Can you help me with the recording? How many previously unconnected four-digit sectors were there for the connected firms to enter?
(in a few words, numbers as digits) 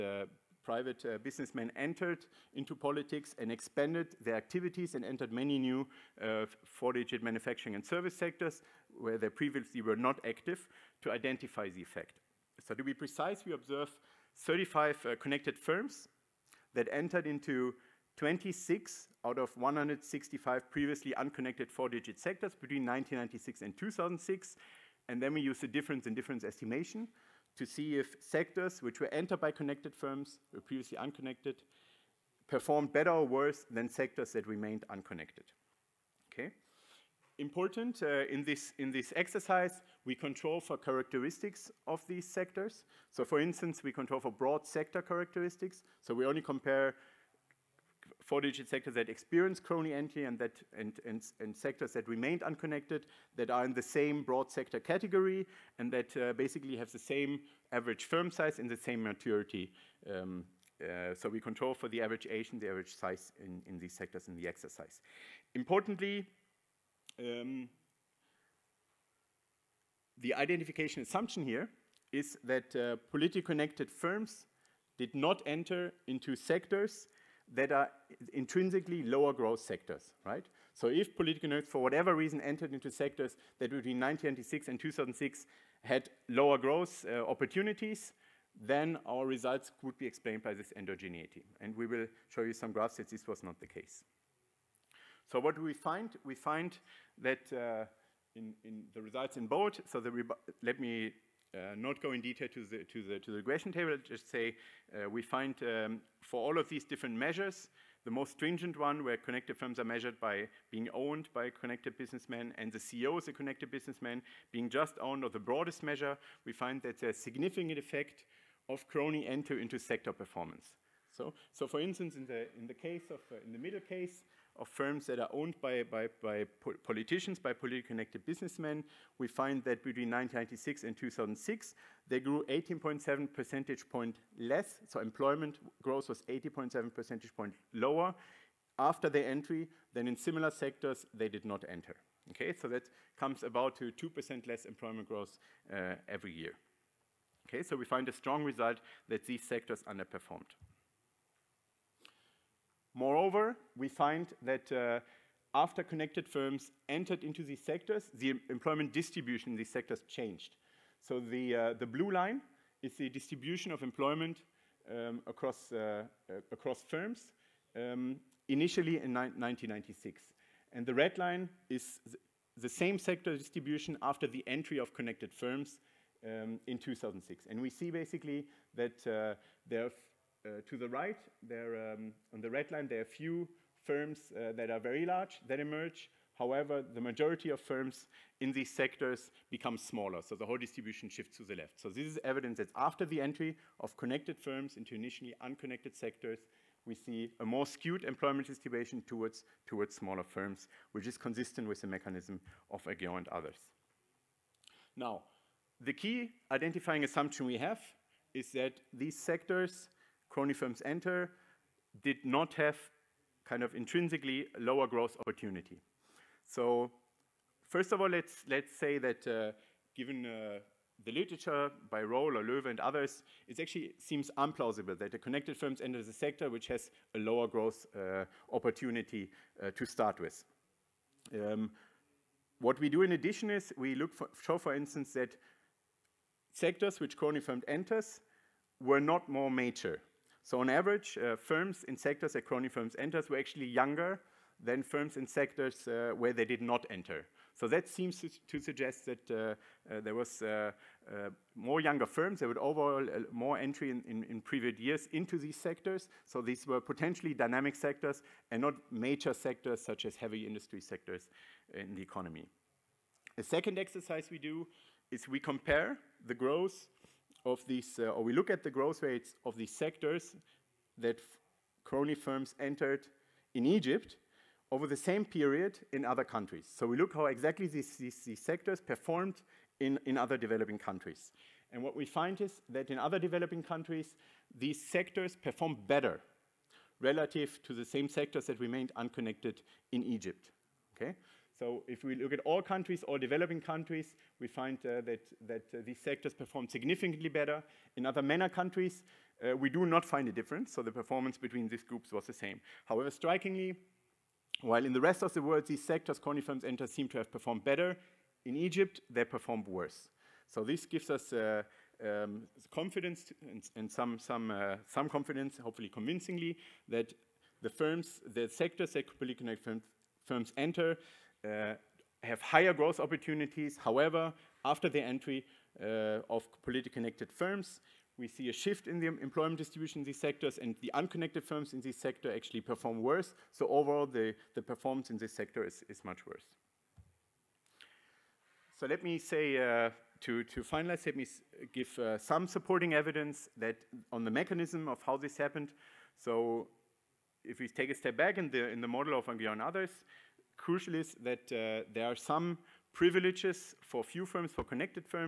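165.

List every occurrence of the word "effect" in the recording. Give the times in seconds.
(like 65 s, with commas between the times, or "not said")
11 s, 117 s.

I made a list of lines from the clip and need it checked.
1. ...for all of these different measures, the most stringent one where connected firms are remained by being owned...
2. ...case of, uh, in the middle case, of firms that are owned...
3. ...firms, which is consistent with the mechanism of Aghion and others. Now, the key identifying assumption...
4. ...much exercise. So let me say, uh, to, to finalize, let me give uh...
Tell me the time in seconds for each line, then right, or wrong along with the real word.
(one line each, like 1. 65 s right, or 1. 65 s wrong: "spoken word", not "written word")
1. 106 s wrong: "measured", not "remained"
2. 122 s right
3. 200 s right
4. 336 s wrong: "worse", not "exercise".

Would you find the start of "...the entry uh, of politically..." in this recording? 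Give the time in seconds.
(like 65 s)
324 s.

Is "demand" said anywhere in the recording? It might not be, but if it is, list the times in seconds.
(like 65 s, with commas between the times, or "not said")
not said.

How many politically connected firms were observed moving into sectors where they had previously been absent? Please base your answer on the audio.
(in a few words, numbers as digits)
35.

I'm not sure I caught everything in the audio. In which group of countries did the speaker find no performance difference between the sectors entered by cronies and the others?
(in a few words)
Other MENA countries.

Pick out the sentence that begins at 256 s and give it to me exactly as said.
So these were potentially dynamic sectors and not major sectors such as heavy industry sectors in the economy.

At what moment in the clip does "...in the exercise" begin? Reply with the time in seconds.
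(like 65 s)
64 s.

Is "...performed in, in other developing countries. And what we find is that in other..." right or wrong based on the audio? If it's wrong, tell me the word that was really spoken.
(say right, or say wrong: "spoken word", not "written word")
right.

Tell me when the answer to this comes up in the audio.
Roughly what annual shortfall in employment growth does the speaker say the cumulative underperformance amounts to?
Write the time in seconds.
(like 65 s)
143 s.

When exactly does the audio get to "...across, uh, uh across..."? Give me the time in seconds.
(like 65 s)
165 s.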